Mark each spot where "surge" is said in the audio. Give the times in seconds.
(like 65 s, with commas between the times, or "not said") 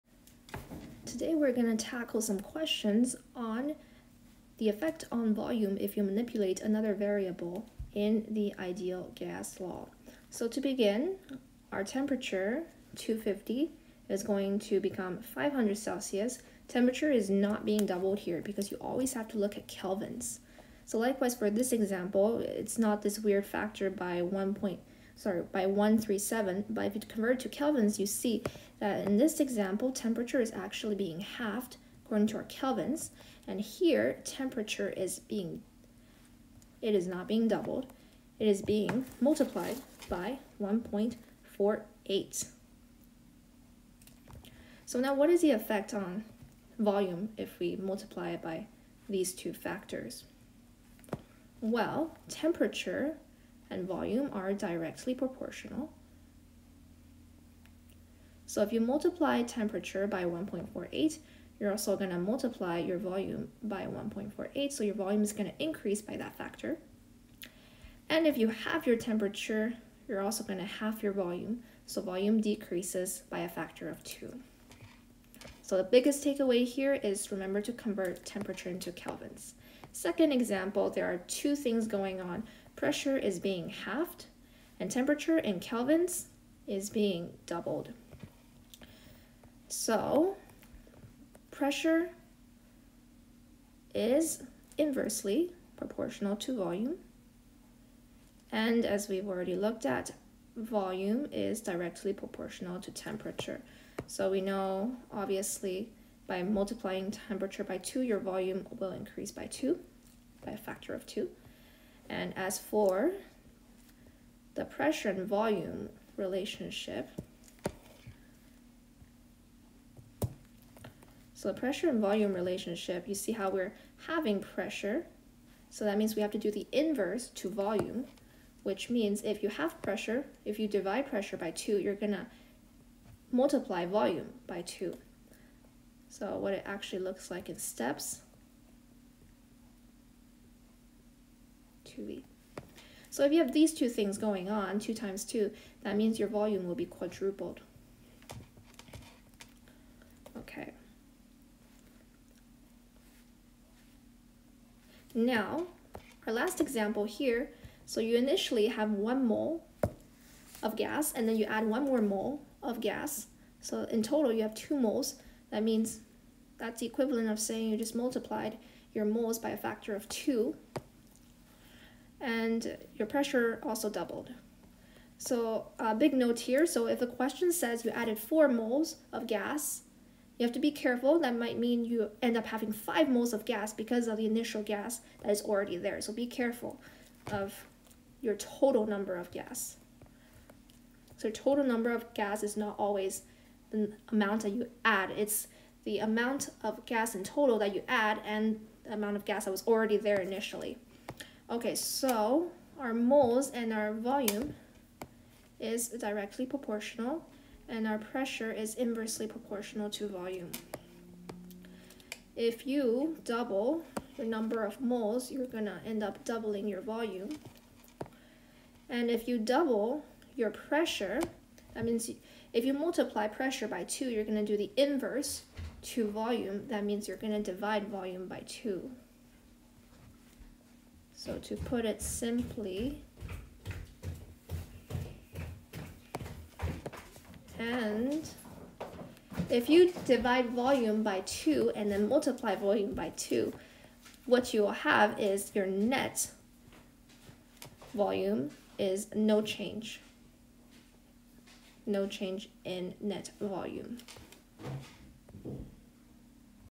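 not said.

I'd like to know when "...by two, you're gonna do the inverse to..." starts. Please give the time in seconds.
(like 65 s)
223 s.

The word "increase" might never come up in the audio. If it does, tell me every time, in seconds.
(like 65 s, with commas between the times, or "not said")
65 s, 108 s.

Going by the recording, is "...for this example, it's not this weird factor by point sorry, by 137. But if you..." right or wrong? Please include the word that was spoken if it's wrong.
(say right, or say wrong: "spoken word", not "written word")
right.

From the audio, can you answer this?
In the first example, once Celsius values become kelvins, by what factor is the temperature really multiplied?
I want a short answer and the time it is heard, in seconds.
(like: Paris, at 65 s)
1.48, at 39 s.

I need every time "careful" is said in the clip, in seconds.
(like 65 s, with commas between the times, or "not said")
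180 s, 186 s.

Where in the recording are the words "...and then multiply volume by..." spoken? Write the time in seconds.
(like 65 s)
241 s.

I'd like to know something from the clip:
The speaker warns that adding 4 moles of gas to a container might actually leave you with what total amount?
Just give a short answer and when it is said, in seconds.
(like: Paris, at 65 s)
5 moles, at 182 s.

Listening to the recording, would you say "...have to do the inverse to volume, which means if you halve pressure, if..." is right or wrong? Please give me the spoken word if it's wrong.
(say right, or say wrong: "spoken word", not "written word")
right.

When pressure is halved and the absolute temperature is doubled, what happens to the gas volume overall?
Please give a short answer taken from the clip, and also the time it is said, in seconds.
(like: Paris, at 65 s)
Quadrupled, at 146 s.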